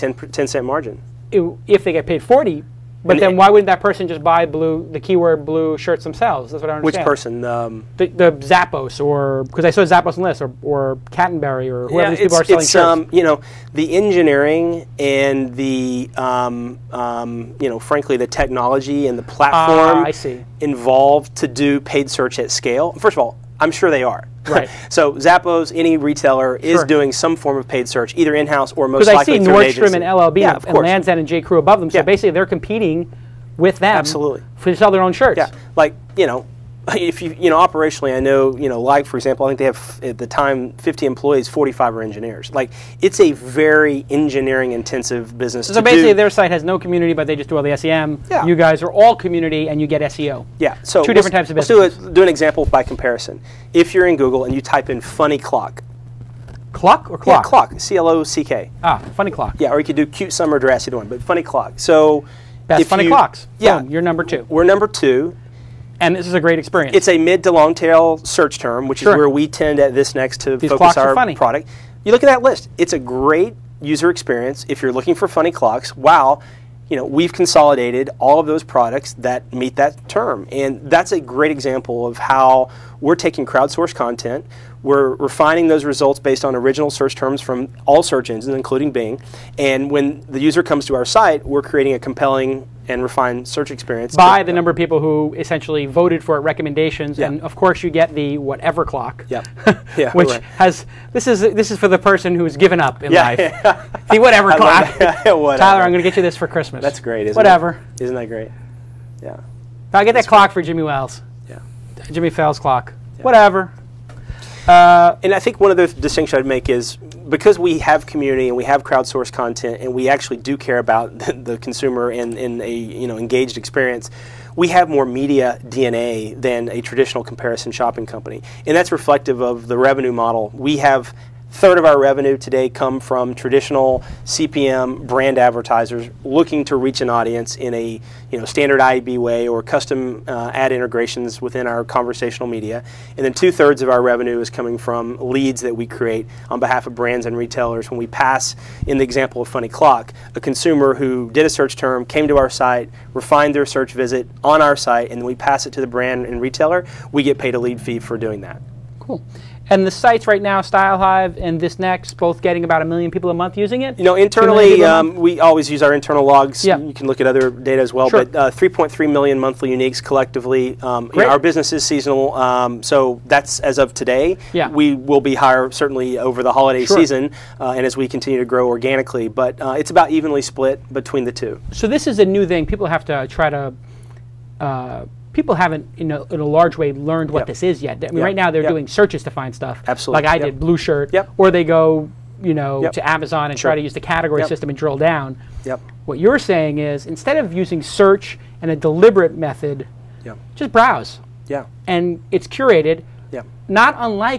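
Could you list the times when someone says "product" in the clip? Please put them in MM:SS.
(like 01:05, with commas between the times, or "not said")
01:11, 01:18.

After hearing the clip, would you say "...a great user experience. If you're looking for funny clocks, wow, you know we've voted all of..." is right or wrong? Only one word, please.
wrong.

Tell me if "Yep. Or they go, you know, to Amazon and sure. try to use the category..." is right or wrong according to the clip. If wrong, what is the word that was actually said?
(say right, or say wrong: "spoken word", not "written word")
right.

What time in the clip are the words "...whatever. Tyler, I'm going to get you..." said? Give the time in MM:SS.
01:44.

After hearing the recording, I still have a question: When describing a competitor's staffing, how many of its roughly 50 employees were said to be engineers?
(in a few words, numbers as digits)
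45.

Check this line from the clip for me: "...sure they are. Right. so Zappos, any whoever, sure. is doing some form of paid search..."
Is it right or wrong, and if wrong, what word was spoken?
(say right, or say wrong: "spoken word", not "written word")
wrong: "retailer", not "whoever".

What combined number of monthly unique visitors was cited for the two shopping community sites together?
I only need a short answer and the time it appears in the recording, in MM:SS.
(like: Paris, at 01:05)
3.3 million, at 02:48.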